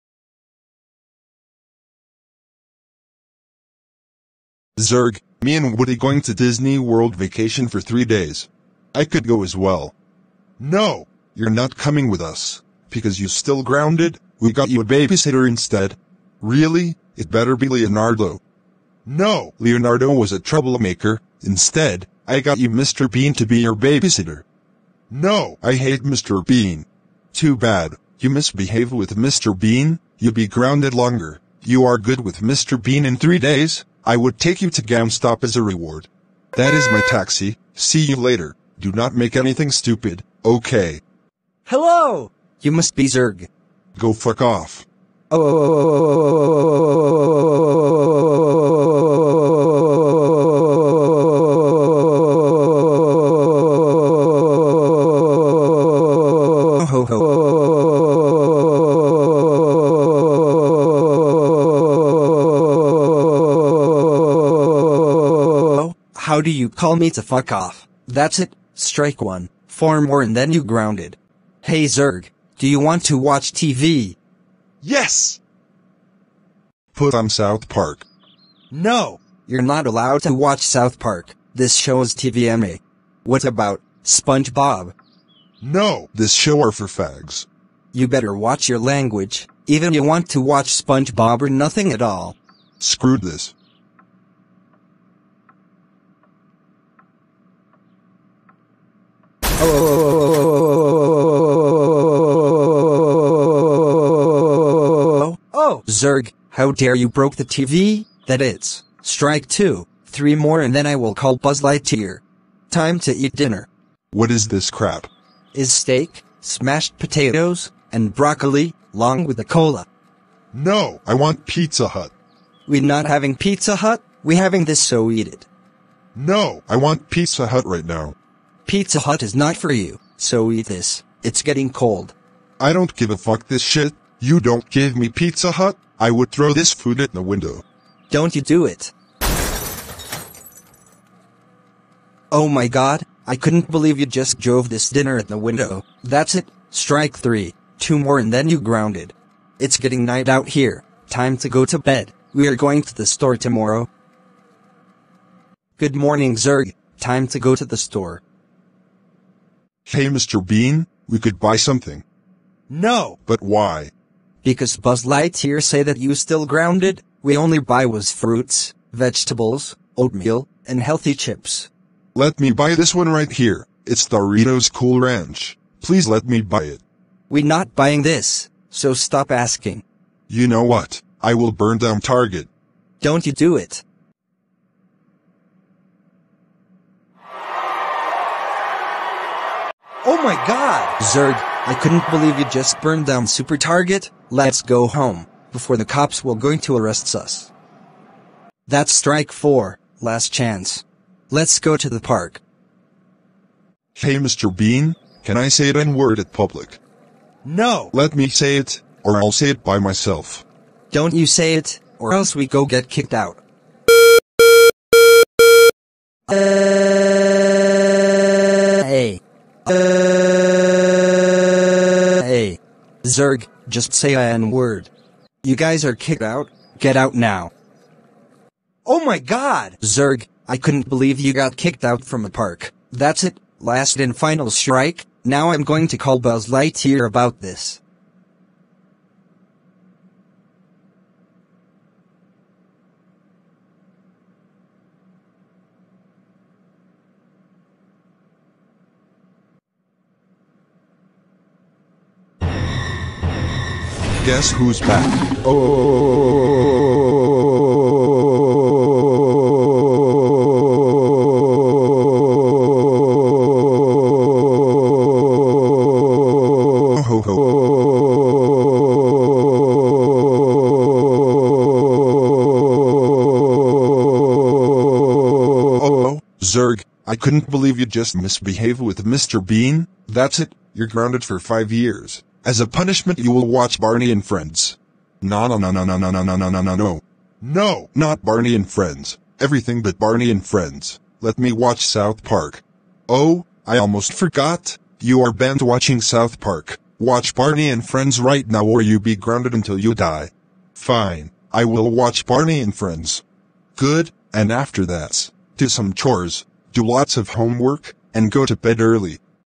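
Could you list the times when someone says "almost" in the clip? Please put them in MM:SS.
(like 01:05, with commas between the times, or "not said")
04:53.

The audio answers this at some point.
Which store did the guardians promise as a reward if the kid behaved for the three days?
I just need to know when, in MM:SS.
00:34.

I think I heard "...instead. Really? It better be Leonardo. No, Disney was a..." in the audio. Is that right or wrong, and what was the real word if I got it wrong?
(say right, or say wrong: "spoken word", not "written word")
wrong: "Leonardo", not "Disney".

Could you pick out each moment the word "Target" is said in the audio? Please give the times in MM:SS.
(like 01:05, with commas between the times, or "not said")
03:02, 03:13.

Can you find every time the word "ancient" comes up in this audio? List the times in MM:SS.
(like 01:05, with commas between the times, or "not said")
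not said.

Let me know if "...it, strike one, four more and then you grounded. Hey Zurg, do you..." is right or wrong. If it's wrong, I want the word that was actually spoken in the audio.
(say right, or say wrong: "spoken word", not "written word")
right.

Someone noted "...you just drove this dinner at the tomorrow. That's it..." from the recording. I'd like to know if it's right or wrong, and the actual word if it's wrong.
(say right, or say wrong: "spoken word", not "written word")
wrong: "window", not "tomorrow".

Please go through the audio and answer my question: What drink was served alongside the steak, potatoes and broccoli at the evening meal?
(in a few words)
Cola.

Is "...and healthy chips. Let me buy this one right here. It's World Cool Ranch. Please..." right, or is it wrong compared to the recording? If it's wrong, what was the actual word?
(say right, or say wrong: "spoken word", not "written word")
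wrong: "Doritos", not "World".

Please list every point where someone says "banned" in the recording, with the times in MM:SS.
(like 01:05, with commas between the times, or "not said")
04:55.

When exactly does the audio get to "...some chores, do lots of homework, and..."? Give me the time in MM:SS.
05:05.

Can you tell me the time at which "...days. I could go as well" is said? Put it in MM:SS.
00:08.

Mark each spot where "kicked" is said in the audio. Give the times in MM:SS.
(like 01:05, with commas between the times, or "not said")
03:32, 03:45, 03:51.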